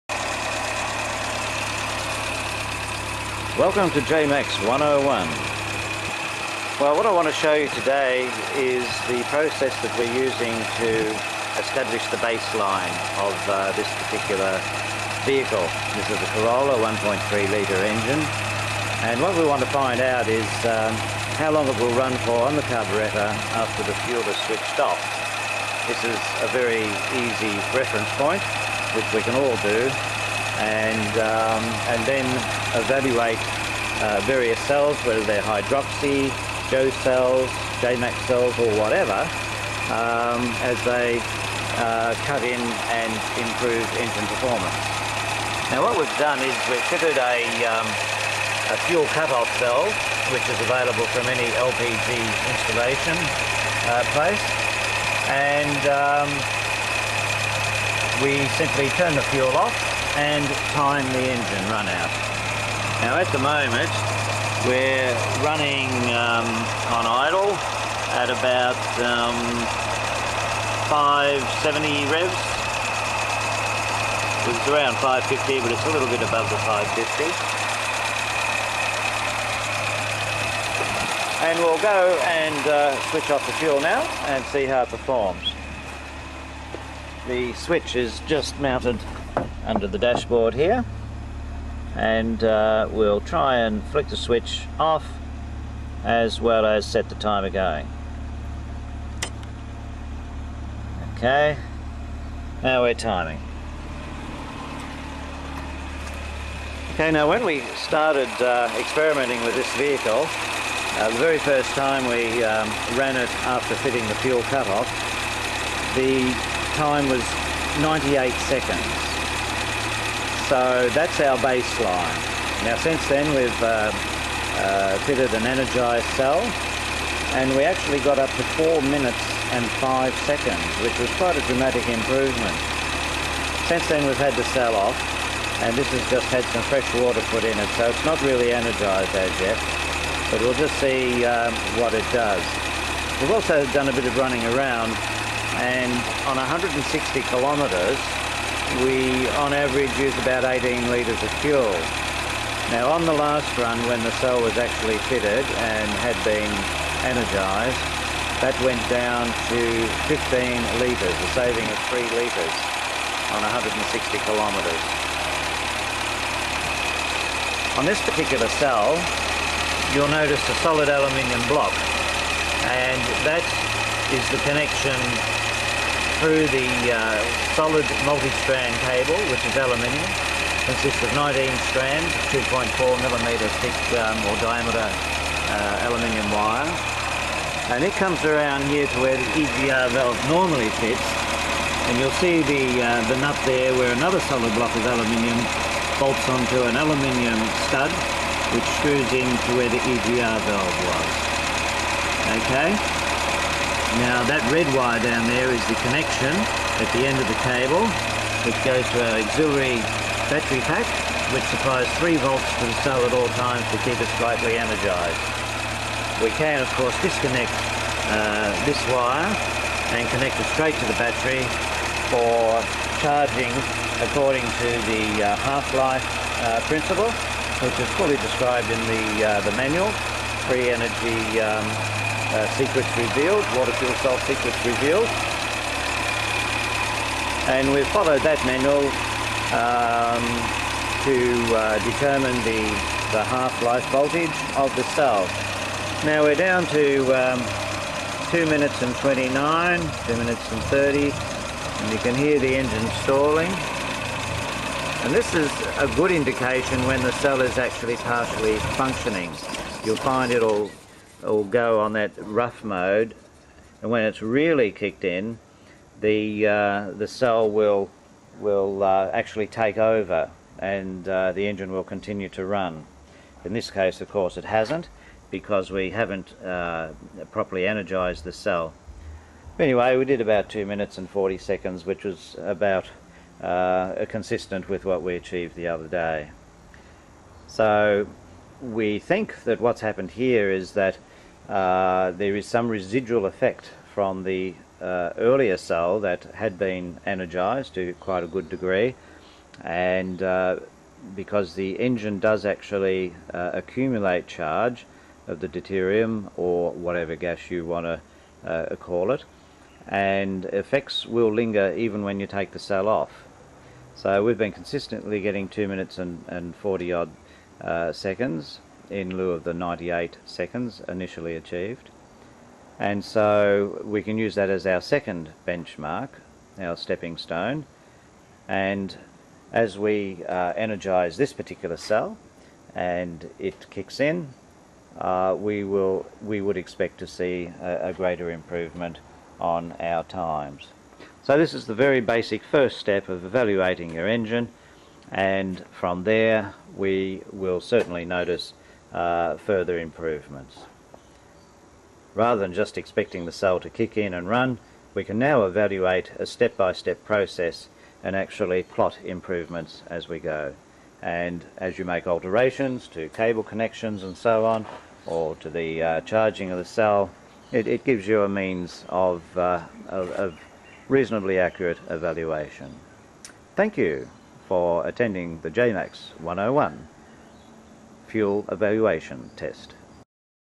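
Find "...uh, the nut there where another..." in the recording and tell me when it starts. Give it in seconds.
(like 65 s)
192 s.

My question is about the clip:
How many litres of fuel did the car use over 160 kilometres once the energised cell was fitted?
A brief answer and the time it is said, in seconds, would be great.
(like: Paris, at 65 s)
15 litres, at 160 s.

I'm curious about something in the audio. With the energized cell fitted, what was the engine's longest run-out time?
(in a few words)
4 minutes 5 seconds.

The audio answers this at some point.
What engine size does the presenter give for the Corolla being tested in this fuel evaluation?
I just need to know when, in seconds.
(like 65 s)
16 s.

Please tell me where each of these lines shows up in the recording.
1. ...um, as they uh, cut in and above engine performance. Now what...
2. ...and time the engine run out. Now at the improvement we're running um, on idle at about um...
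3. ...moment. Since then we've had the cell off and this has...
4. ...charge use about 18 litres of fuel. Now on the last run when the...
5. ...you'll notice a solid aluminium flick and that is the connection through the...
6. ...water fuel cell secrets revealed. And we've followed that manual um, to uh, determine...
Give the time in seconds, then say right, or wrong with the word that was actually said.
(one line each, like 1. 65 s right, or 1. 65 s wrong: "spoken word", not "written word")
1. 39 s wrong: "improve", not "above"
2. 60 s wrong: "moment", not "improvement"
3. 131 s wrong: "improvement", not "moment"
4. 149 s wrong: "average", not "charge"
5. 169 s wrong: "block", not "flick"
6. 233 s right.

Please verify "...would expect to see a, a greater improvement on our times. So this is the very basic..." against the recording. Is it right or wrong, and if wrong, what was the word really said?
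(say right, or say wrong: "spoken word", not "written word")
right.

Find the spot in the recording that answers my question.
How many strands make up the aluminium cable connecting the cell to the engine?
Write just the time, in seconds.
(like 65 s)
181 s.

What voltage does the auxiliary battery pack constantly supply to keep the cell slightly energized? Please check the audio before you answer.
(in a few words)
3 volts.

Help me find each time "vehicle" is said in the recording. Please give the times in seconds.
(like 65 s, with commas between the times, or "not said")
15 s, 109 s.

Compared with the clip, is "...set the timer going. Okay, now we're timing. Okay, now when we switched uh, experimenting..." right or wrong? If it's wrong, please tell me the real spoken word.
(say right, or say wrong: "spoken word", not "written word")
wrong: "started", not "switched".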